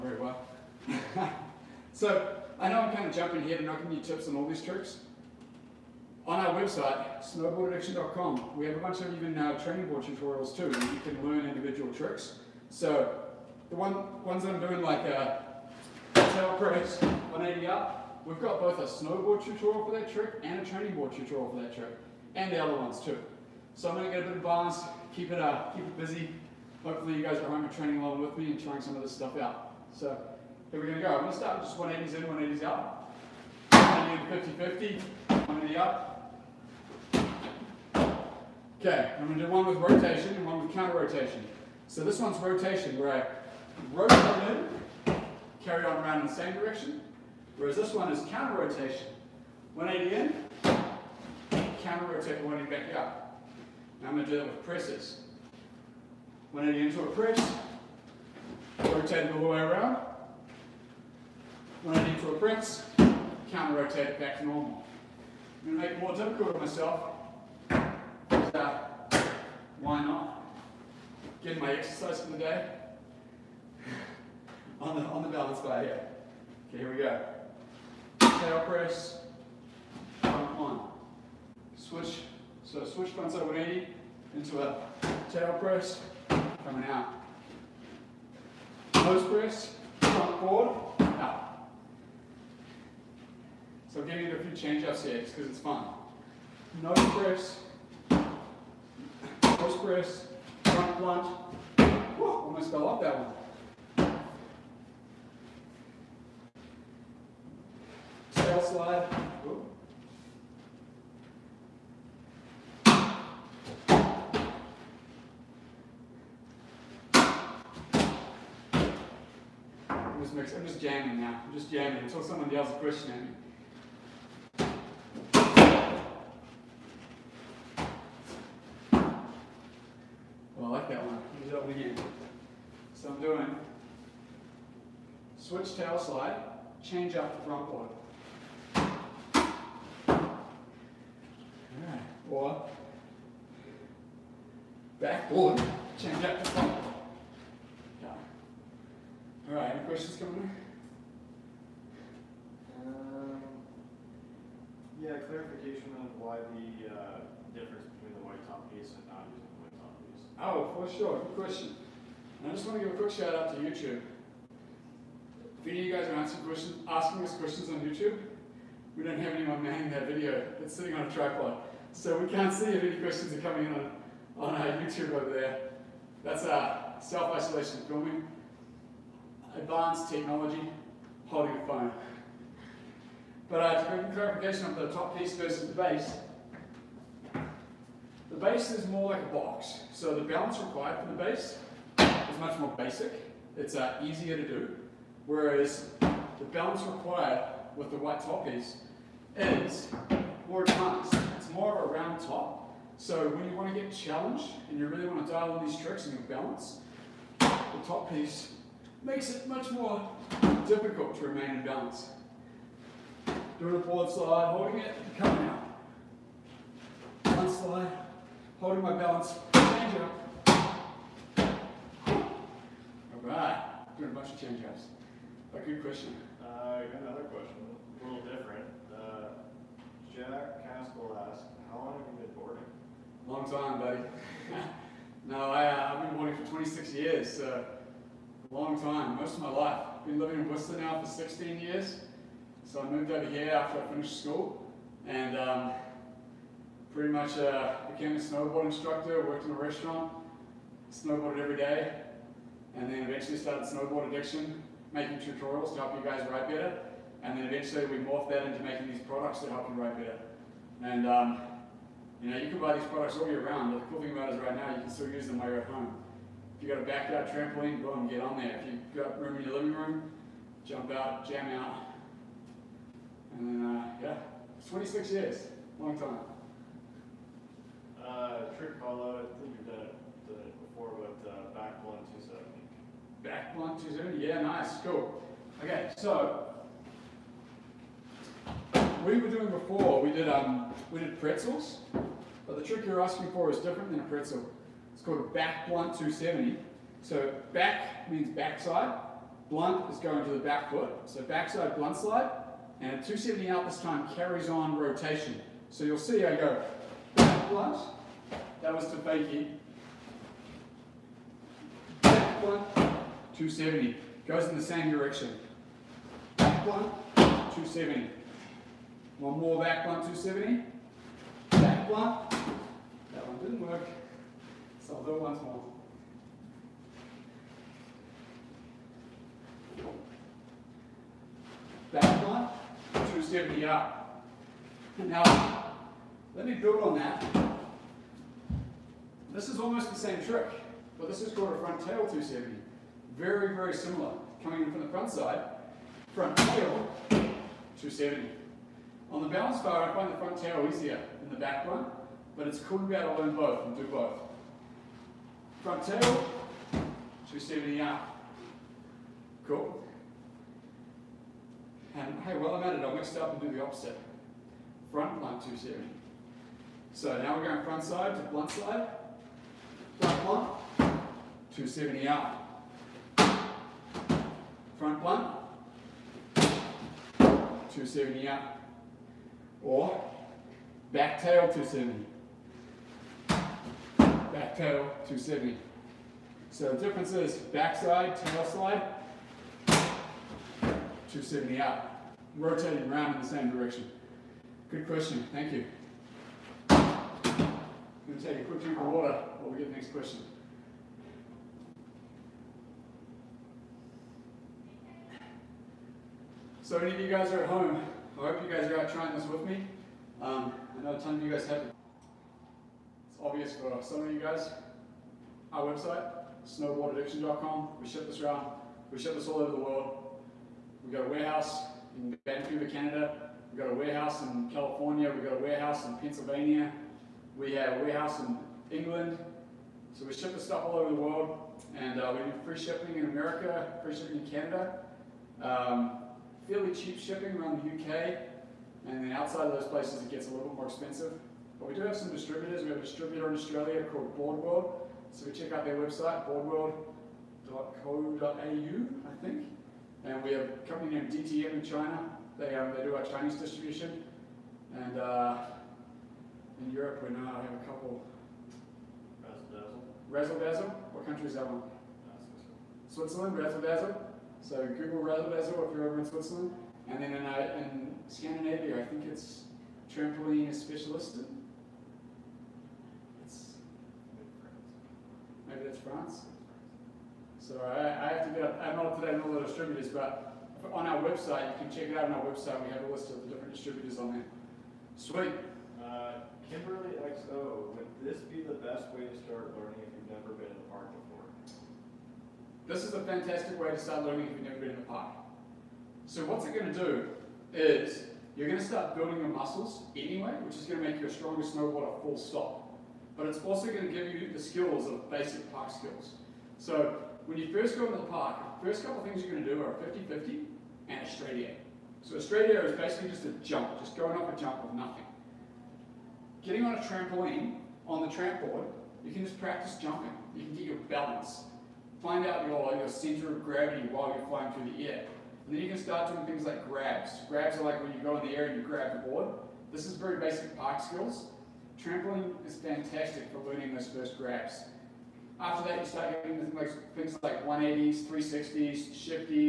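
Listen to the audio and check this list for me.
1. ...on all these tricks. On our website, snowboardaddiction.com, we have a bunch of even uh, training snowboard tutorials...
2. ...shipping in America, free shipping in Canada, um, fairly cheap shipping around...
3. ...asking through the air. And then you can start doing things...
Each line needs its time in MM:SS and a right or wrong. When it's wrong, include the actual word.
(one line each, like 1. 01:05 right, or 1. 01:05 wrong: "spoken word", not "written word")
1. 00:04 wrong: "board", not "snowboard"
2. 07:12 right
3. 08:44 wrong: "flying", not "asking".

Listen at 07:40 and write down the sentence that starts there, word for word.
Razzle What country is that one?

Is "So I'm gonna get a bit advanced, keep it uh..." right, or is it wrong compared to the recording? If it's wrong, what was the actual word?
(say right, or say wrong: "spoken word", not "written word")
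right.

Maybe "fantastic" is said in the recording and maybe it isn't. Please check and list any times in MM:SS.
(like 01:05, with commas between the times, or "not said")
08:13, 08:52.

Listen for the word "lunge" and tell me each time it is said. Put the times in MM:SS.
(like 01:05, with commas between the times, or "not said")
01:41.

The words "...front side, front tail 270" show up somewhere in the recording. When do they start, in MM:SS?
05:44.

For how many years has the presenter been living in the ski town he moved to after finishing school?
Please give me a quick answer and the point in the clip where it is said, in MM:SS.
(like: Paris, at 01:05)
16, at 04:01.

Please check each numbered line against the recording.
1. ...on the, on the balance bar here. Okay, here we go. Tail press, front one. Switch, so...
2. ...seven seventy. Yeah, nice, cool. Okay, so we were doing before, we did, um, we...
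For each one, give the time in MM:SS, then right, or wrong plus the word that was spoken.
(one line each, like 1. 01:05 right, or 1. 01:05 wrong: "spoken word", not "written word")
1. 01:14 right
2. 04:43 wrong: "two", not "seven".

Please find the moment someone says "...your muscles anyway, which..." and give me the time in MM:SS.
08:19.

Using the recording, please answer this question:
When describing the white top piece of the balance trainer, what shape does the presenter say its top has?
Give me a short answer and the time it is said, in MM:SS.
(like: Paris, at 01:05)
Round top, at 03:21.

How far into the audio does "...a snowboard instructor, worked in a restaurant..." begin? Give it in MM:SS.
04:08.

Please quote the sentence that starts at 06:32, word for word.
Rotating around in the same direction.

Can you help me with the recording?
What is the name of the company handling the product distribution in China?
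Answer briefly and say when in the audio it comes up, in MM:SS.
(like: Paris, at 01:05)
DTM, at 07:31.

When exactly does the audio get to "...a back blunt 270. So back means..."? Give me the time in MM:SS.
04:55.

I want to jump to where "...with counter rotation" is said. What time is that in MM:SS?
00:40.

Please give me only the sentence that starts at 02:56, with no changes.
That's our self-isolation filming, advanced technology, holding a phone.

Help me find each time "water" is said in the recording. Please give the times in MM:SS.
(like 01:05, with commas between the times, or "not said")
06:38.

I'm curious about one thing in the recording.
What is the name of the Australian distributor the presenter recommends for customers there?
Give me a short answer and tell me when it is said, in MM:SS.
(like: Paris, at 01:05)
Boardworld, at 07:24.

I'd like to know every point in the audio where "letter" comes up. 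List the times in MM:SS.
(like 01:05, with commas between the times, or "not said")
not said.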